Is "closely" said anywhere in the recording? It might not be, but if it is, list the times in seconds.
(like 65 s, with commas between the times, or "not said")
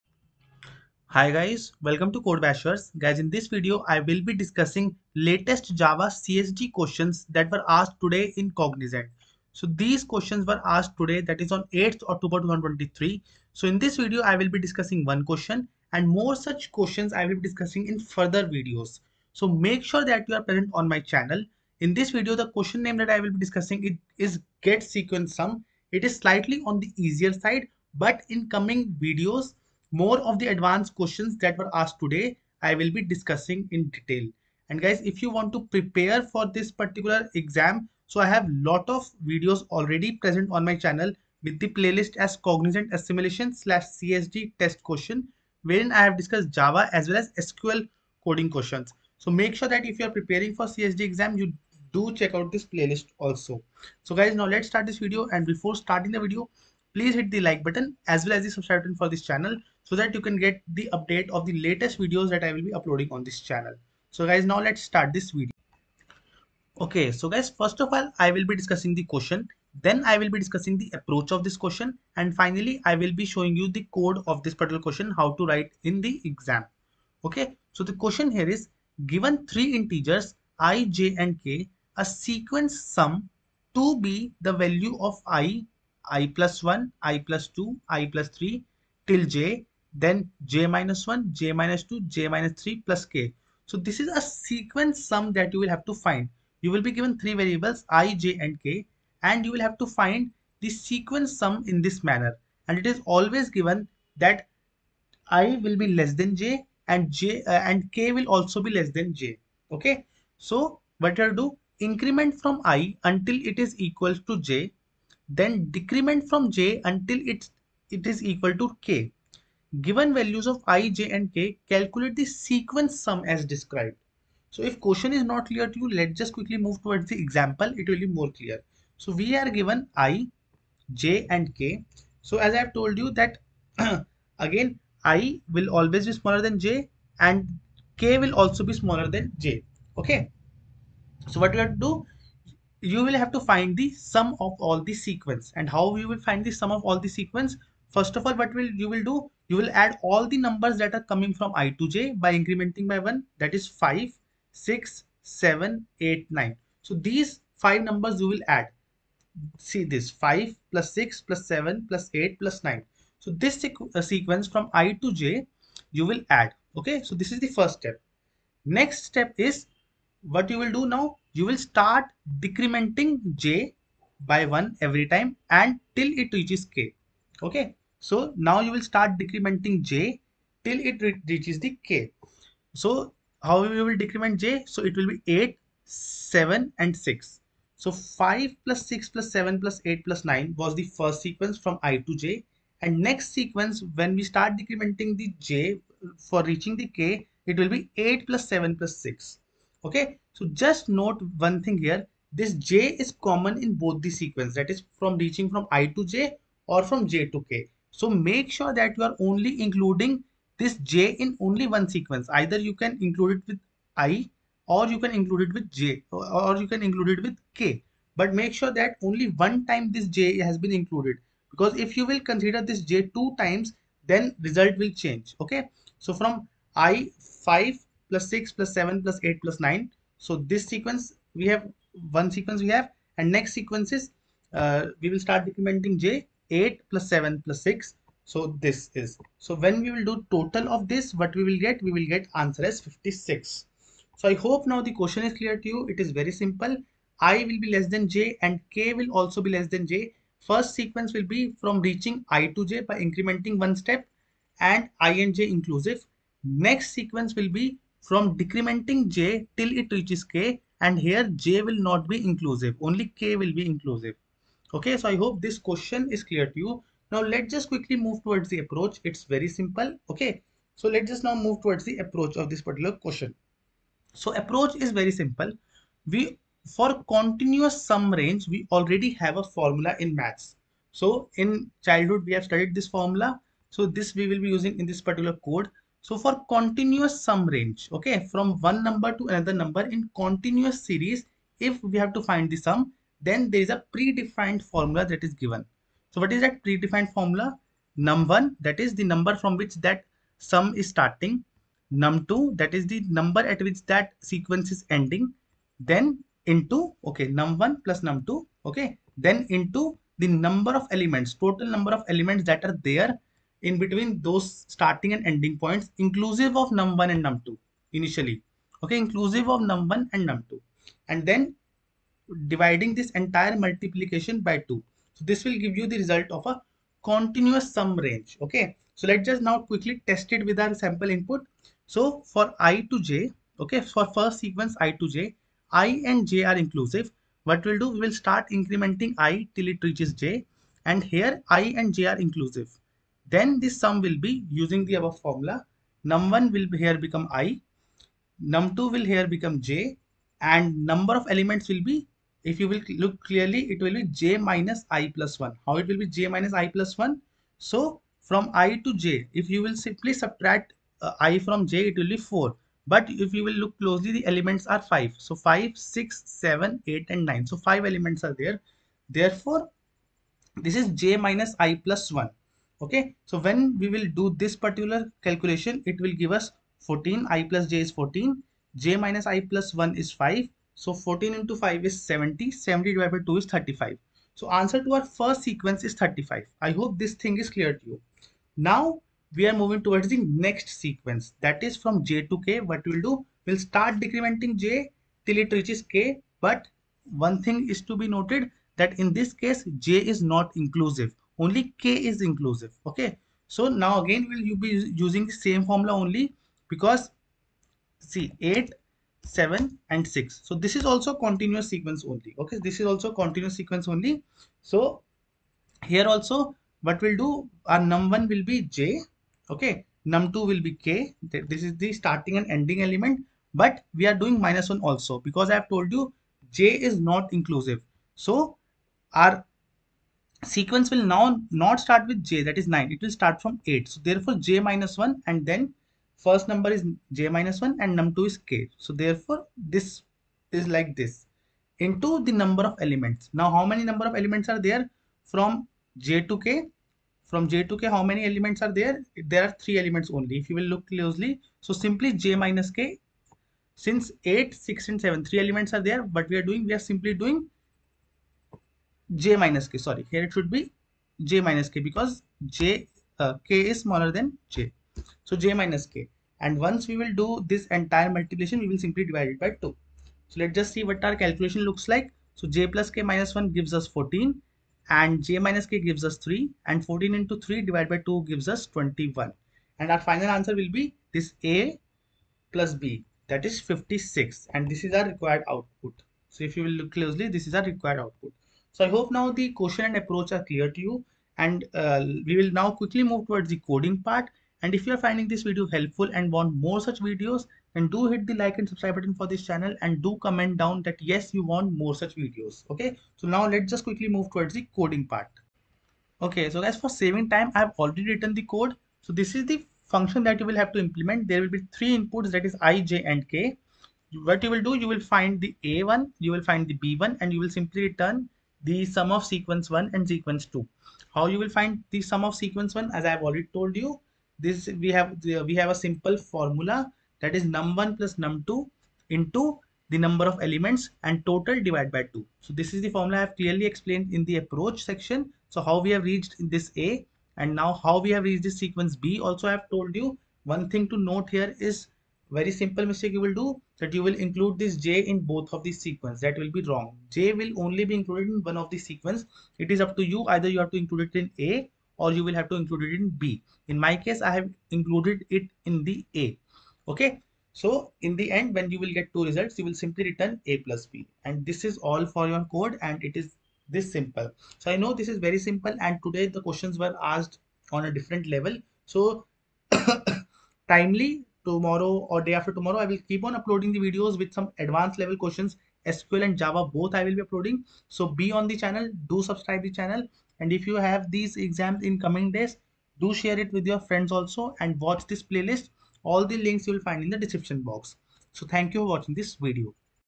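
363 s, 450 s, 486 s.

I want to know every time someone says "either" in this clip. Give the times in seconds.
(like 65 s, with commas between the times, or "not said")
212 s, 550 s.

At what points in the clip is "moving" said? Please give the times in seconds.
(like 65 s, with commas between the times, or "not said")
389 s.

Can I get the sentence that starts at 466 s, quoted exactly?
And once we will do this entire multiplication, we will simply divide it by 2.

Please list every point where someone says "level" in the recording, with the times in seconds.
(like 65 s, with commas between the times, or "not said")
568 s, 574 s.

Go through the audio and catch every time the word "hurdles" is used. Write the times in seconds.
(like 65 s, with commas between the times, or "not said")
not said.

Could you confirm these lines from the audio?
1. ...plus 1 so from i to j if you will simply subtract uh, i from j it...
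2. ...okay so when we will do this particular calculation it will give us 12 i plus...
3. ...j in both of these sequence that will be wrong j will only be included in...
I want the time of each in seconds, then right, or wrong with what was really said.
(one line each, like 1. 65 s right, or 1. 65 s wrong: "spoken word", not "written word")
1. 356 s right
2. 372 s wrong: "14", not "12"
3. 544 s right.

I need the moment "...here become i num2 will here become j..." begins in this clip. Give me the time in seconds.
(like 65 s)
346 s.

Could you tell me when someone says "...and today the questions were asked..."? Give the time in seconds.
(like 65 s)
565 s.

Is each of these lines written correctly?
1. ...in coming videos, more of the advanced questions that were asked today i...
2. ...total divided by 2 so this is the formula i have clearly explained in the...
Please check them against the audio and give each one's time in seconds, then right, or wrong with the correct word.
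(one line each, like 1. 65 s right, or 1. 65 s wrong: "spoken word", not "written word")
1. 28 s right
2. 531 s right.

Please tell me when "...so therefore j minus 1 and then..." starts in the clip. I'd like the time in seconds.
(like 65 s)
433 s.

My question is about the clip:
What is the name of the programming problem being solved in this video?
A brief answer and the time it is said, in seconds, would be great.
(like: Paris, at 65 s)
get sequence sum, at 24 s.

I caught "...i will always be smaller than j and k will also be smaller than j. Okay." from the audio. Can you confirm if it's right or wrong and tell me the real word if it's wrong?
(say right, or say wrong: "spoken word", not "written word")
right.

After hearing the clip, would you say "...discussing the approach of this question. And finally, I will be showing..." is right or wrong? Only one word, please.
right.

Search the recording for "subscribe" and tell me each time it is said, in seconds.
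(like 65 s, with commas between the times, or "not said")
58 s, 498 s, 579 s.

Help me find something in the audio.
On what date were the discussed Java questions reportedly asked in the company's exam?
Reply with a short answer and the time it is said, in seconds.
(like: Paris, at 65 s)
8th October 2023, at 11 s.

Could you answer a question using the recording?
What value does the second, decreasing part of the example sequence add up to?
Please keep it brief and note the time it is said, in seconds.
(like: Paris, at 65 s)
21, at 478 s.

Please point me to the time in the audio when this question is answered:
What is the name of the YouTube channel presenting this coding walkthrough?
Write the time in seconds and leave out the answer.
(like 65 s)
2 s.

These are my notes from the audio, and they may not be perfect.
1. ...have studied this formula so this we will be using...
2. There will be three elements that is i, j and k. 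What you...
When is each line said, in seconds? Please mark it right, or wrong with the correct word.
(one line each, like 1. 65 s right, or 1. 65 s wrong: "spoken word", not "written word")
1. 282 s right
2. 511 s wrong: "inputs", not "elements".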